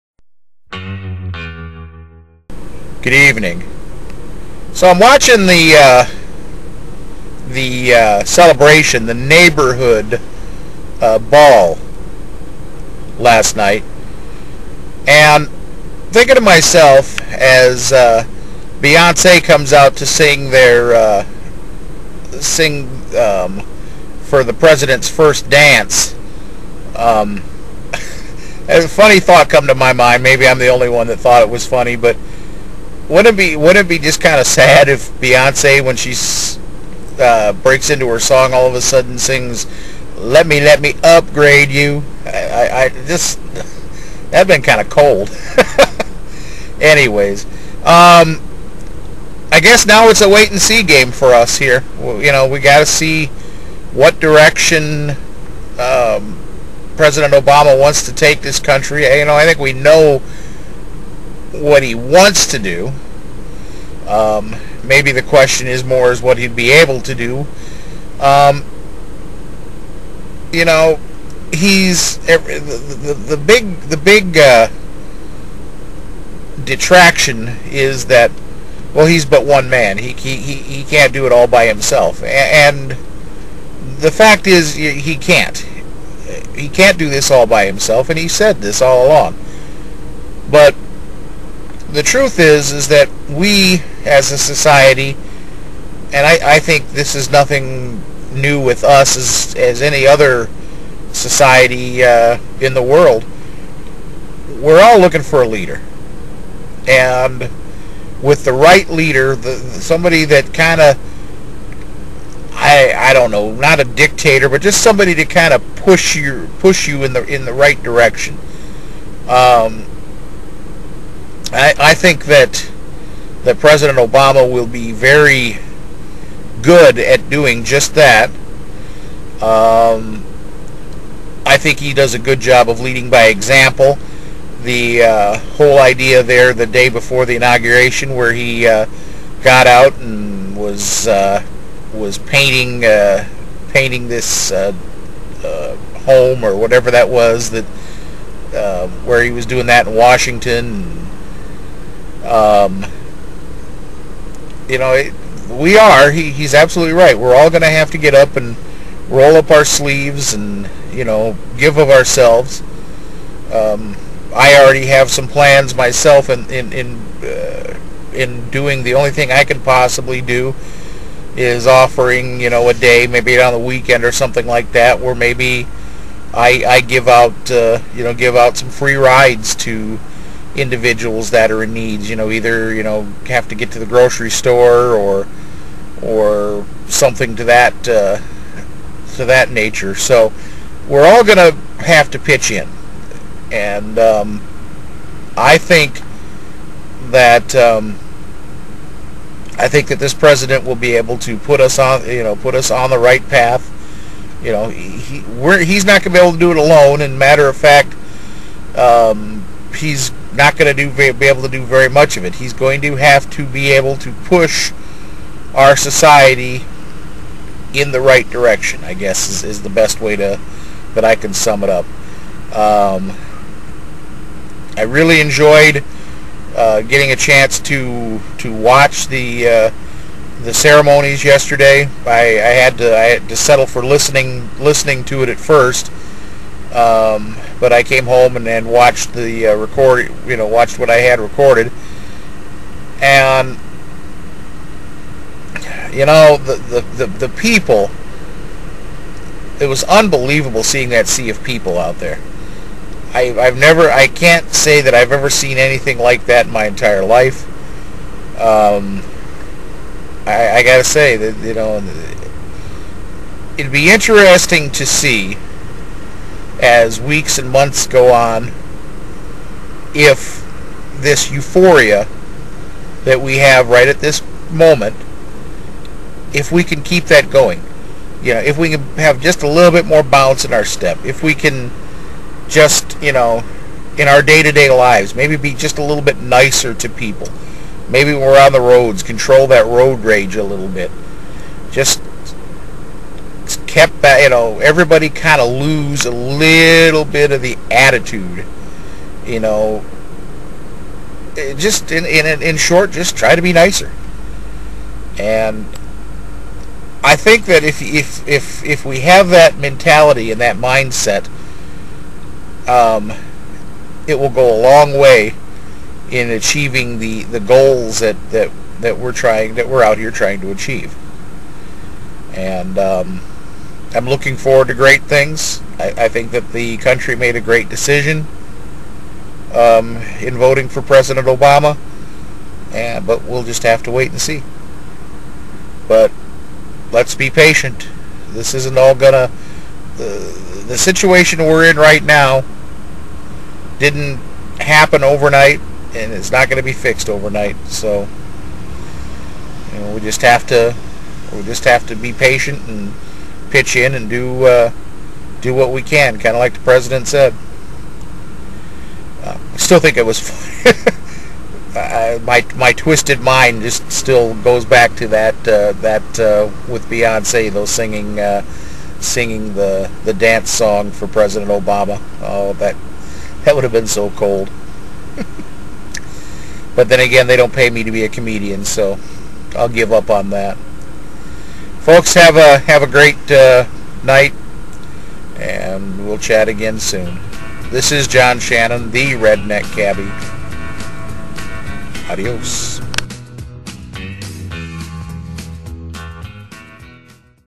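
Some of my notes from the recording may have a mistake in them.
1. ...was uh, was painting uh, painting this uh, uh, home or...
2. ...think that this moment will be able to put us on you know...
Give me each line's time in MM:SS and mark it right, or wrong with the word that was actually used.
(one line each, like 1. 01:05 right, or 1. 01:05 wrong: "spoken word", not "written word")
1. 02:20 right
2. 03:19 wrong: "president", not "moment".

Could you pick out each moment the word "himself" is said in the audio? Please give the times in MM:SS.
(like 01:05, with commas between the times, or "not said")
01:21, 01:27.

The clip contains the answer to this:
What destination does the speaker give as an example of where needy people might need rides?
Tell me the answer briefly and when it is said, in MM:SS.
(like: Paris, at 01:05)
grocery store, at 03:03.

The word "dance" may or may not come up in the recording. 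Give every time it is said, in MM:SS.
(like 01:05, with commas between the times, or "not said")
00:25, 06:10.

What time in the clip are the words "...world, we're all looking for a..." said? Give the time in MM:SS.
01:42.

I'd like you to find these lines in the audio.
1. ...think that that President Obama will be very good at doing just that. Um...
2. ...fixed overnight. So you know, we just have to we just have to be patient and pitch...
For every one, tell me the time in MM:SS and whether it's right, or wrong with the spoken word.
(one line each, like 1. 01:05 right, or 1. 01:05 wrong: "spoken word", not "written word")
1. 02:01 right
2. 05:46 right.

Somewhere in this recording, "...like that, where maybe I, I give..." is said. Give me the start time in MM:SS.
02:54.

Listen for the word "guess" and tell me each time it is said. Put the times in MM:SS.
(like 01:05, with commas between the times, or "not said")
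00:49, 03:38.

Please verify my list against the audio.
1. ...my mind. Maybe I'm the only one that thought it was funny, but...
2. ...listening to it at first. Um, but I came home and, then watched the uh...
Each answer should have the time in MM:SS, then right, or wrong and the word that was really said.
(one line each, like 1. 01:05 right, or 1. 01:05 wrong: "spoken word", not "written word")
1. 00:29 right
2. 03:54 right.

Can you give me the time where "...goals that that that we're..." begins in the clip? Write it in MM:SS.
05:17.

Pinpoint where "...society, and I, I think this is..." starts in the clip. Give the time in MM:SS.
01:34.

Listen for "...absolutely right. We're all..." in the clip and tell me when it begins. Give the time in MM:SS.
02:36.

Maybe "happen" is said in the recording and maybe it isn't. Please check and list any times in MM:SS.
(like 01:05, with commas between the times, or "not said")
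05:44.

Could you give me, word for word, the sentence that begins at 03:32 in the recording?
He's going to have to be able to push our society in the right direction.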